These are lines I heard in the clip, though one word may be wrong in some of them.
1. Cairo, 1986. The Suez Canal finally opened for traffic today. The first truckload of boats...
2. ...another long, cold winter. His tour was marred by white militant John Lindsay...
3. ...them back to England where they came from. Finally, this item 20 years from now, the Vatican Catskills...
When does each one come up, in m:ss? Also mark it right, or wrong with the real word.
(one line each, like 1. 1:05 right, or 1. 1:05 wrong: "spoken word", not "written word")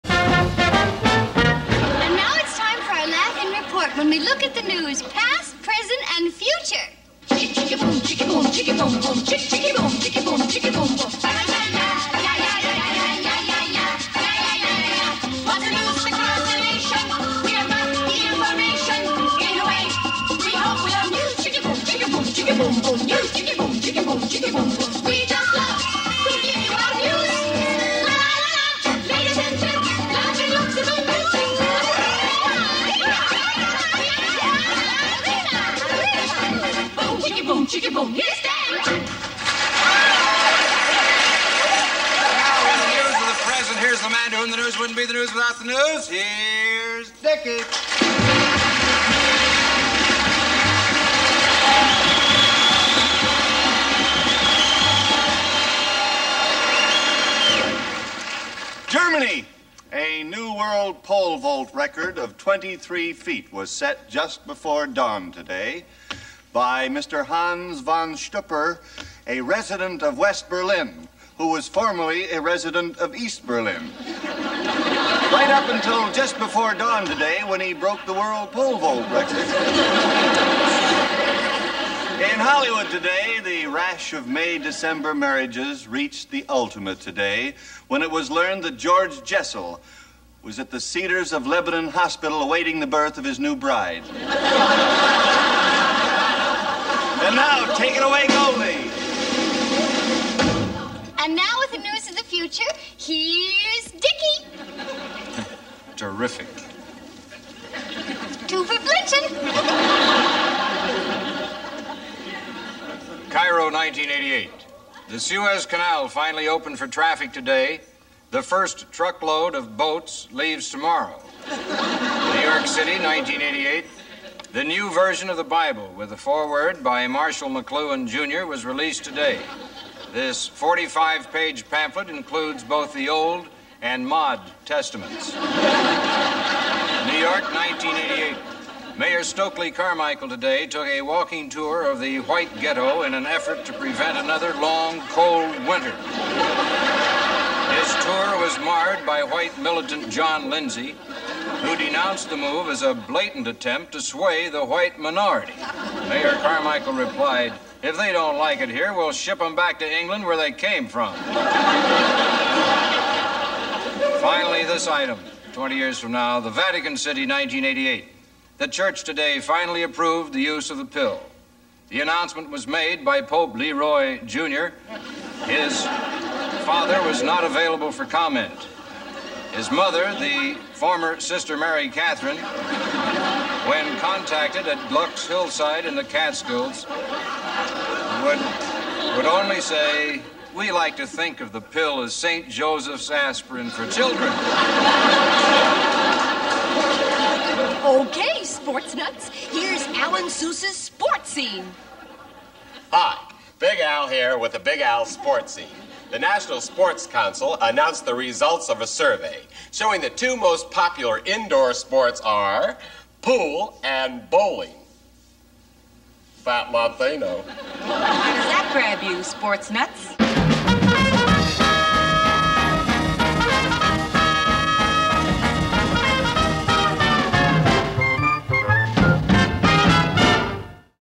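1. 1:53 wrong: "1988", not "1986"
2. 2:24 right
3. 2:39 wrong: "City", not "Catskills".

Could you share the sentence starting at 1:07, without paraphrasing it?
Hans von Stupper, a resident of West Berlin, who was formerly a resident of East Berlin.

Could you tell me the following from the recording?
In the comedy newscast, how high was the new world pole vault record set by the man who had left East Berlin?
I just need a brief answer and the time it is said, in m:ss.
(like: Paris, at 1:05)
23 feet, at 1:02.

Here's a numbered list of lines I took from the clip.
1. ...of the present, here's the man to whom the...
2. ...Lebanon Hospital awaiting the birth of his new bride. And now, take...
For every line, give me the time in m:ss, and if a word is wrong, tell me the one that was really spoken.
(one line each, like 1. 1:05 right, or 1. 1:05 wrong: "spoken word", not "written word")
1. 0:43 right
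2. 1:31 right.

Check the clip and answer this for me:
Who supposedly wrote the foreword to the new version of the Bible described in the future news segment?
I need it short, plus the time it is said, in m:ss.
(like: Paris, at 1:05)
Marshall McLuhan Jr., at 2:07.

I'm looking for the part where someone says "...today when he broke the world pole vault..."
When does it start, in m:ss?
1:17.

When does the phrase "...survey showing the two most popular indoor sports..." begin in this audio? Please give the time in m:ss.
3:28.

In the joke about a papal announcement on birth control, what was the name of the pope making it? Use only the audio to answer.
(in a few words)
Pope Leroy Jr.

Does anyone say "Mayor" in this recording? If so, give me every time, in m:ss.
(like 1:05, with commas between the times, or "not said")
2:18, 2:36.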